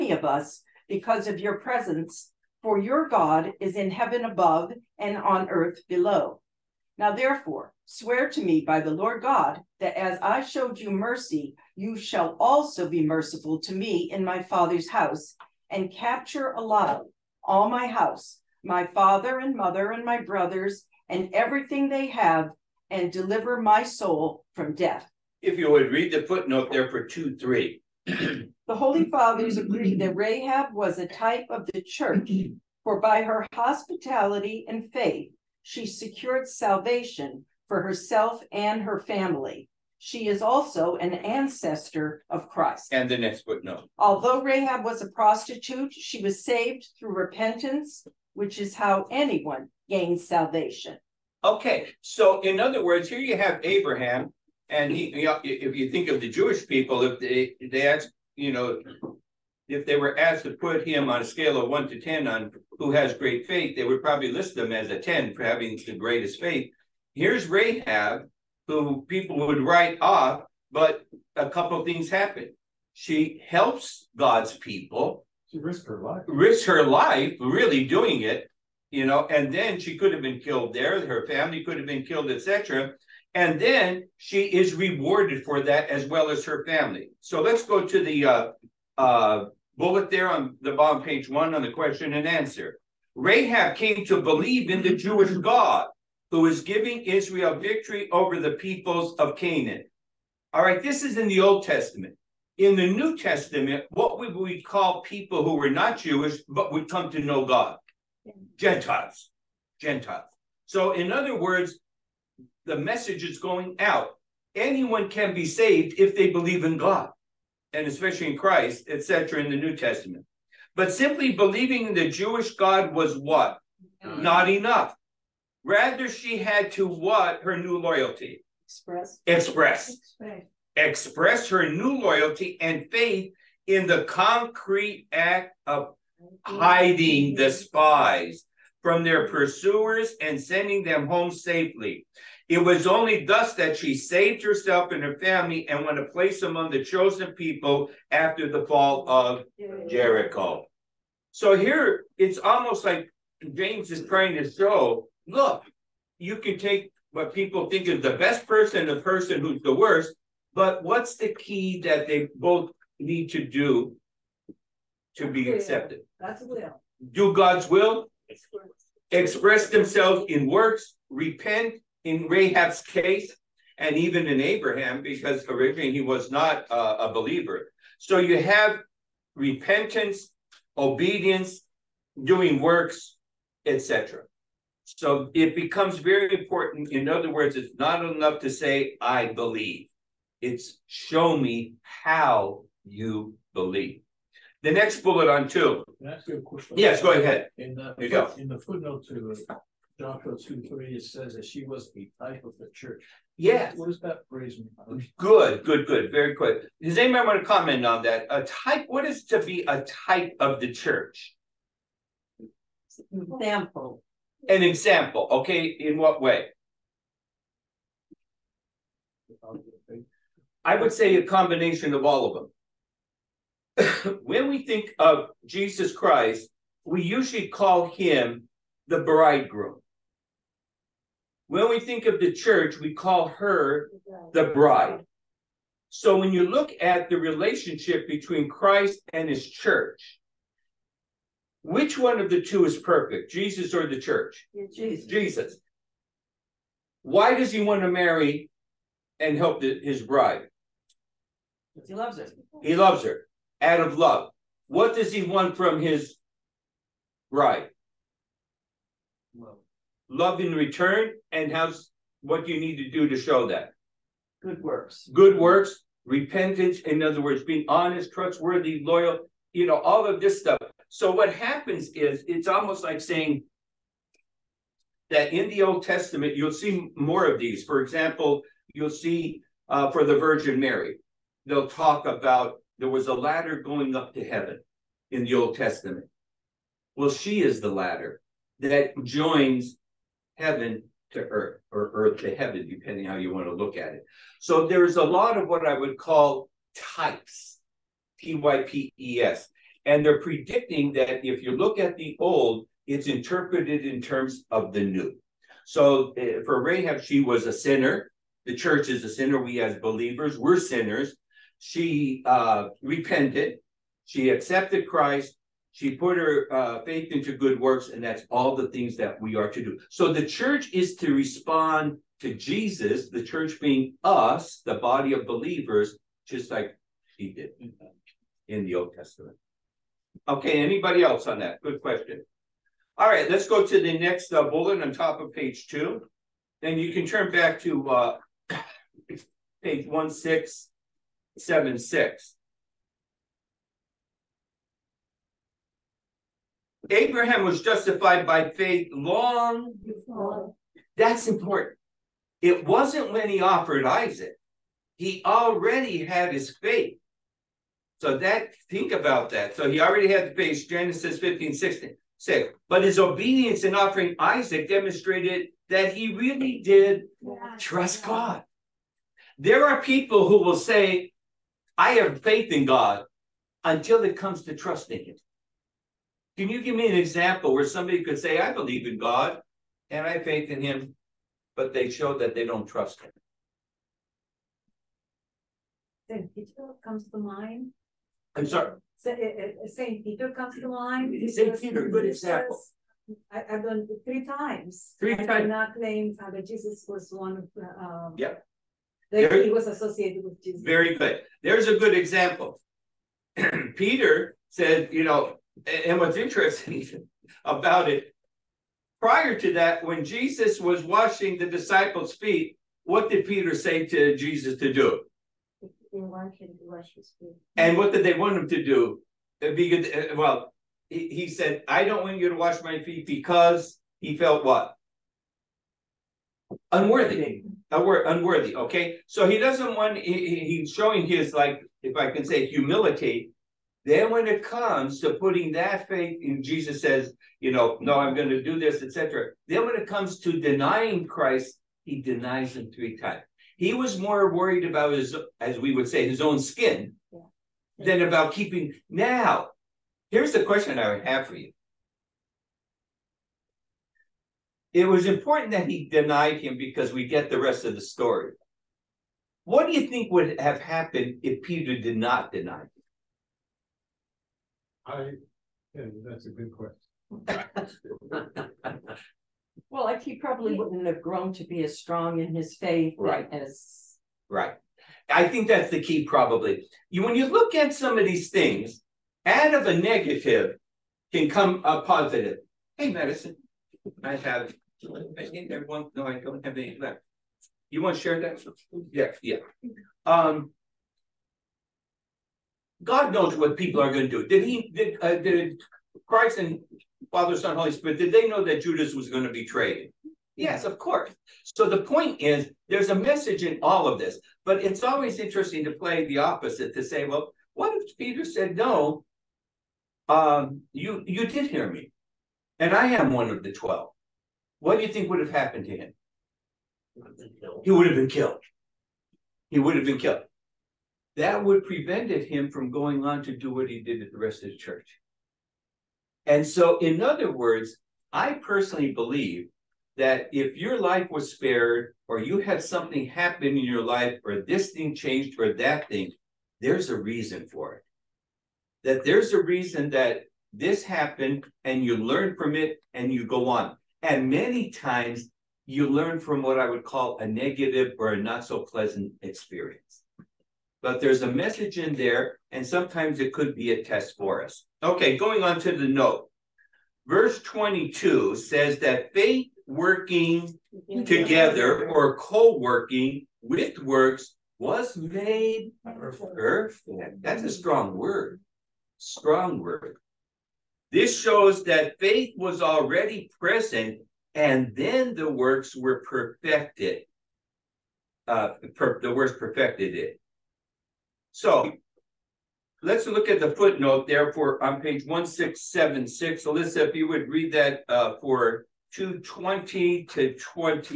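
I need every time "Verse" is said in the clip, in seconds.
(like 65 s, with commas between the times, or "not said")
557 s.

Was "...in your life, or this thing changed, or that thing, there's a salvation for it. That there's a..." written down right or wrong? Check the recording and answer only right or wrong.
wrong.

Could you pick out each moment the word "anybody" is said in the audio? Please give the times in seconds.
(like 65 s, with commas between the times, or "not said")
206 s, 330 s.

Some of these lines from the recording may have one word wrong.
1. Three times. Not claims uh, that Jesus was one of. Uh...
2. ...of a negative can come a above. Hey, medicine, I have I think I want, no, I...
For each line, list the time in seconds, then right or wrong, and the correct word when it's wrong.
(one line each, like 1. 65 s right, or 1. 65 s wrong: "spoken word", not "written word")
1. 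394 s right
2. 479 s wrong: "positive", not "above".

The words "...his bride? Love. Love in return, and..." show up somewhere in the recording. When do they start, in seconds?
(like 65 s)
255 s.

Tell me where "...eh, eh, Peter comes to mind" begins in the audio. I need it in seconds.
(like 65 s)
389 s.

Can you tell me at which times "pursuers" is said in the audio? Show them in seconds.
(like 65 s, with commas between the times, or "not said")
139 s.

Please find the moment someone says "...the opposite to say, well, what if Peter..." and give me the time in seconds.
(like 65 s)
506 s.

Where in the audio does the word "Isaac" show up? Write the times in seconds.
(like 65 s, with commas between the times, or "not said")
353 s, 364 s.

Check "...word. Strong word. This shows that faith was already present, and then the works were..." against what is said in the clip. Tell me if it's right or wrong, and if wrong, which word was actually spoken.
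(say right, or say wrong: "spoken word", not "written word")
right.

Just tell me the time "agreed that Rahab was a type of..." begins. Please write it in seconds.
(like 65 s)
29 s.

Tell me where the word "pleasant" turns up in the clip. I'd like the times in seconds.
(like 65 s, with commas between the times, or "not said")
548 s.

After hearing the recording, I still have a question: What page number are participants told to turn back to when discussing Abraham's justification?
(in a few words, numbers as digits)
1676.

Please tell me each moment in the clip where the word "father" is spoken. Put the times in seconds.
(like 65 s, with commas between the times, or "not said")
14 s, 18 s, 29 s, 497 s.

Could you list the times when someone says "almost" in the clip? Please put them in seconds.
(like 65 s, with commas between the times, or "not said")
152 s, 272 s.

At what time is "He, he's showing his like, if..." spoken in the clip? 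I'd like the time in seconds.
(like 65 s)
429 s.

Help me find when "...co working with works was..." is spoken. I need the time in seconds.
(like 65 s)
562 s.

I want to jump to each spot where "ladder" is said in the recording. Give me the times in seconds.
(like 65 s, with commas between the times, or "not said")
283 s, 287 s.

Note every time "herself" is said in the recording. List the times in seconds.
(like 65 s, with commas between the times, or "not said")
37 s, 144 s.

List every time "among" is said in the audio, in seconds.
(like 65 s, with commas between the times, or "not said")
146 s.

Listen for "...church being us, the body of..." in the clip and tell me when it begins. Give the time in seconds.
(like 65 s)
323 s.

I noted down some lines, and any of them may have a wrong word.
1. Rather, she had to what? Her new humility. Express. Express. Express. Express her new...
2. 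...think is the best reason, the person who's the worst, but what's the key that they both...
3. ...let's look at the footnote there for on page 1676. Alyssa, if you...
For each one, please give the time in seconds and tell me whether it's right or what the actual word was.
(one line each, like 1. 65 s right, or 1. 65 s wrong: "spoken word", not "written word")
1. 125 s wrong: "loyalty", not "humility"
2. 157 s wrong: "person", not "reason"
3. 582 s right.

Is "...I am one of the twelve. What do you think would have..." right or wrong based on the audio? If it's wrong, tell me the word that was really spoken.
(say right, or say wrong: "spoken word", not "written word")
right.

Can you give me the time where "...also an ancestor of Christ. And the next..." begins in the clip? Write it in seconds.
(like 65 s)
40 s.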